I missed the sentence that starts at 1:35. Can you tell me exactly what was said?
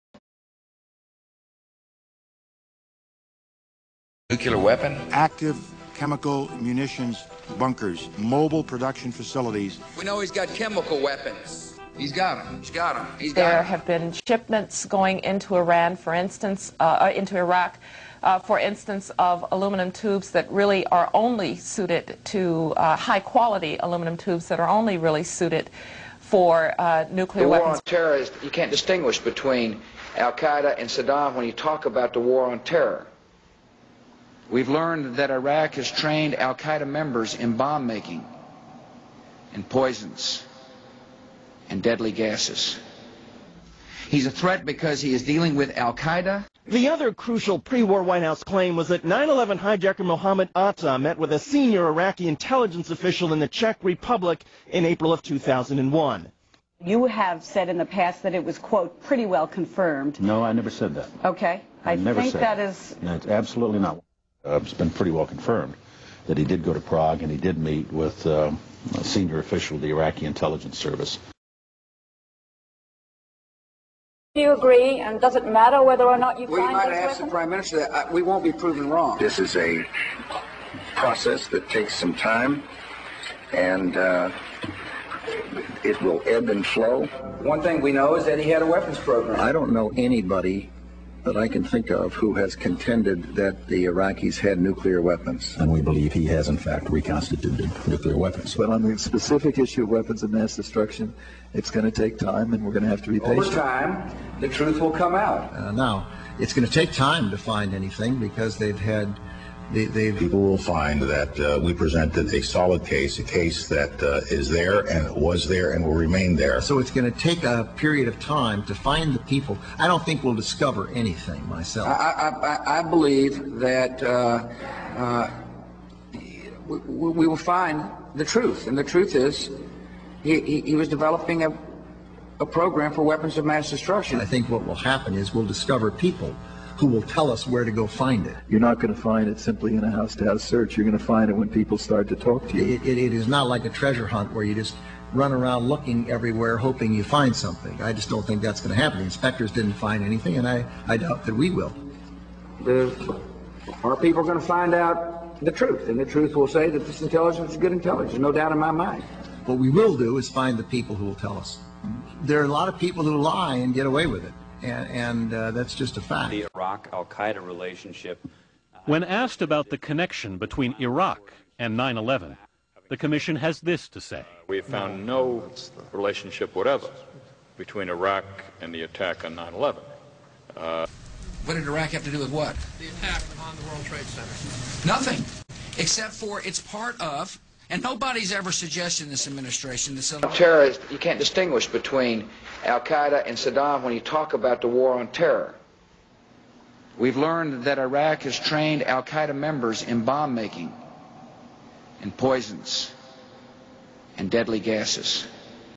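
And we believe he has, in fact, reconstituted nuclear weapons.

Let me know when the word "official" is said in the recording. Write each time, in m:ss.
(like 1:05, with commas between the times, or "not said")
0:52, 1:09.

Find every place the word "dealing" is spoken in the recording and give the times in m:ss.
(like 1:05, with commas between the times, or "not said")
0:45.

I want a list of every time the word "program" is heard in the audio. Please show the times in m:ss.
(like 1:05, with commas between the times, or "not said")
1:28, 2:12.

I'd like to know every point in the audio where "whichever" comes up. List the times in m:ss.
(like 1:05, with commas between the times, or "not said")
not said.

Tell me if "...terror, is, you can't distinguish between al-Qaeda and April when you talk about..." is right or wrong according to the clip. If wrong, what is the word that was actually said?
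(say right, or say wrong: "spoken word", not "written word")
wrong: "Saddam", not "April".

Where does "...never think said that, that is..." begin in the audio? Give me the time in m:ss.
1:01.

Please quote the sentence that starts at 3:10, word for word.
Terrorist, you can't distinguish between Al Qaeda and Saddam when you talk about the war on terror.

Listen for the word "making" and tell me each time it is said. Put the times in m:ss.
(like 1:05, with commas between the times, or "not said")
0:37, 3:20.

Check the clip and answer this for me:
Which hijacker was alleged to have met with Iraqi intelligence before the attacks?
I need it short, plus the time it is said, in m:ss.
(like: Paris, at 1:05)
Mohammed Atta, at 0:50.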